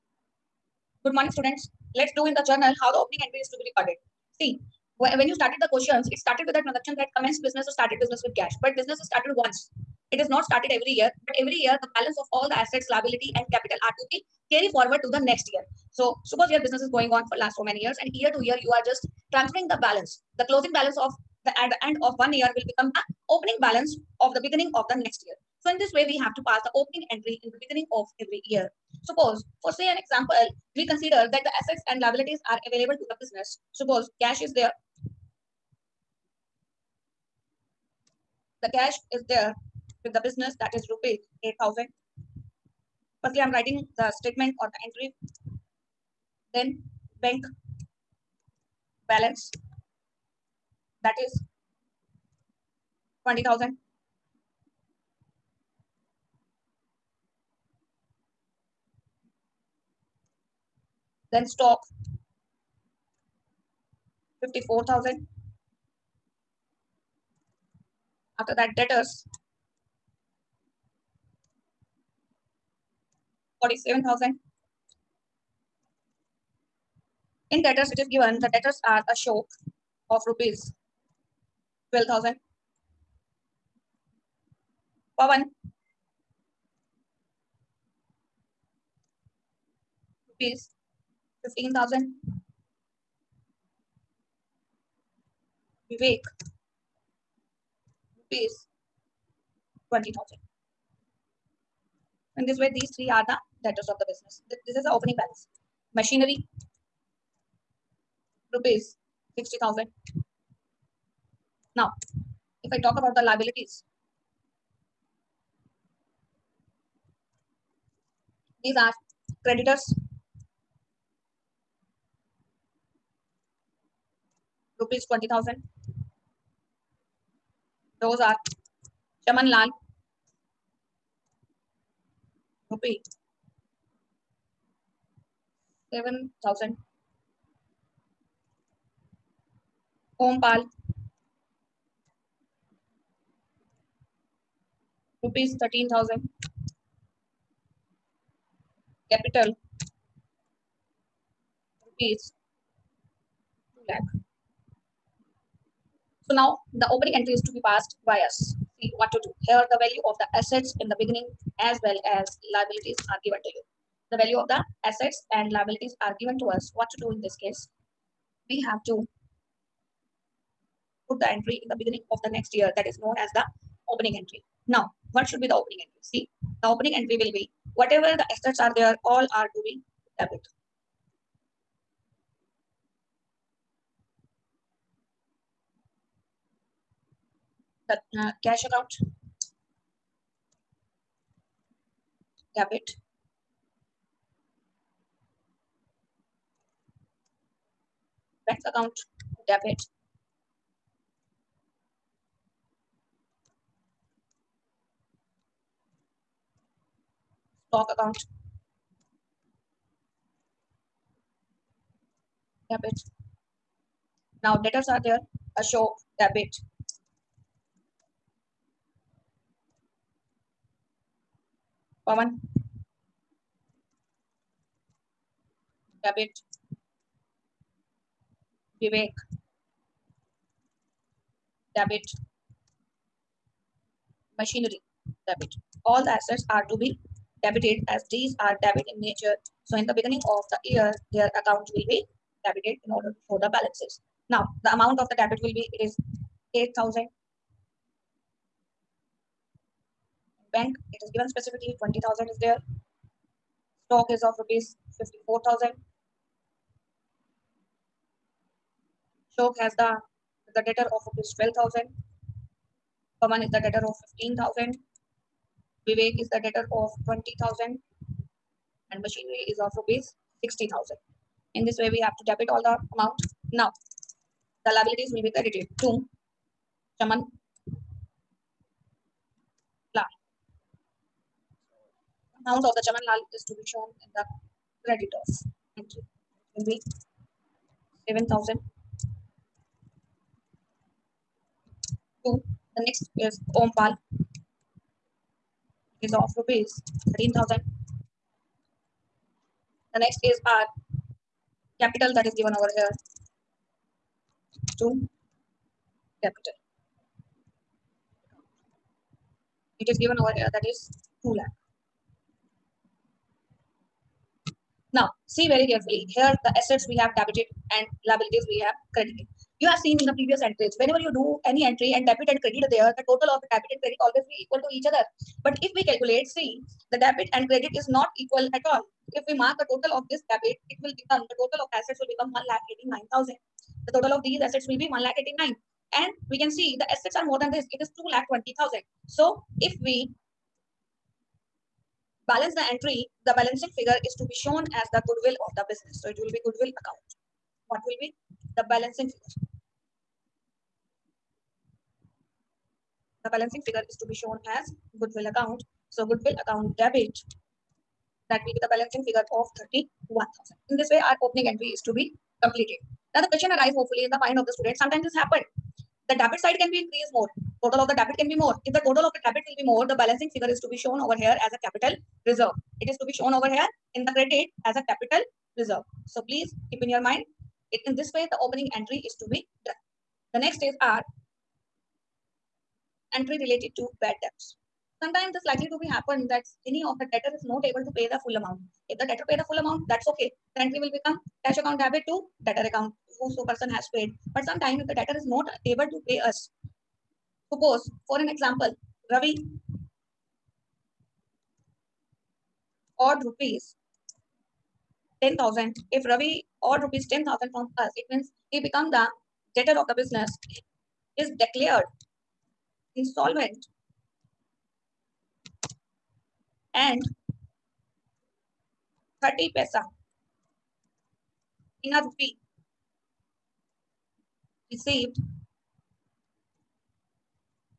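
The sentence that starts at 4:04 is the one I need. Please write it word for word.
Now, the amount of the debit will be, it is 8,000.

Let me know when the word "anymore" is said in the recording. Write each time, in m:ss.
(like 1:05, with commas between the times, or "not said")
not said.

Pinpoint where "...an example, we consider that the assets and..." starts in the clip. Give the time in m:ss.
0:29.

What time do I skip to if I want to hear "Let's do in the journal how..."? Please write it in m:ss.
0:01.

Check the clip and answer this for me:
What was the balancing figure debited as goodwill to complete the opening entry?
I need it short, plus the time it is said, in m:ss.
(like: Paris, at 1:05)
31,000, at 5:59.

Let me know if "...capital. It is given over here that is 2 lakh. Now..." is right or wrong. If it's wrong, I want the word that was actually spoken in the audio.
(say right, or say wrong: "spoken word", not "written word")
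right.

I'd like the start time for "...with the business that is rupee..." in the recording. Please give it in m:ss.
0:40.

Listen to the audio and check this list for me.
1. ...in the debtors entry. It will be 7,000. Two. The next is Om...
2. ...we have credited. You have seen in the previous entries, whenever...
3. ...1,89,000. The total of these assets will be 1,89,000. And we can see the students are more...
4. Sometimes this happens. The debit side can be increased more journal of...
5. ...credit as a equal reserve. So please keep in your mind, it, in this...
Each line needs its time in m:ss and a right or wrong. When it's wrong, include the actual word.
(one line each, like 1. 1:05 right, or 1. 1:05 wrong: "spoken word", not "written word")
1. 4:44 wrong: "creditors", not "debtors"
2. 5:18 right
3. 5:32 wrong: "assets", not "students"
4. 6:04 wrong: "total", not "journal"
5. 6:14 wrong: "capital", not "equal".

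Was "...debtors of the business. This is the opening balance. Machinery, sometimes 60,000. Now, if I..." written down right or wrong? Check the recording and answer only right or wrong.
wrong.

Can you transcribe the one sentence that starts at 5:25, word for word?
But if we calculate, see, the debit and credit is not equal at all.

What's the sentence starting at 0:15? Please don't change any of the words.
So suppose your business is going on for last so many years and year to year you are just transferring the balance.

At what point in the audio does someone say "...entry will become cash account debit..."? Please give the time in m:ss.
6:30.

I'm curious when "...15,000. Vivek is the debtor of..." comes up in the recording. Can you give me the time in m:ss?
4:24.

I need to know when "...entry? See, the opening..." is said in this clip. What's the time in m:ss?
2:55.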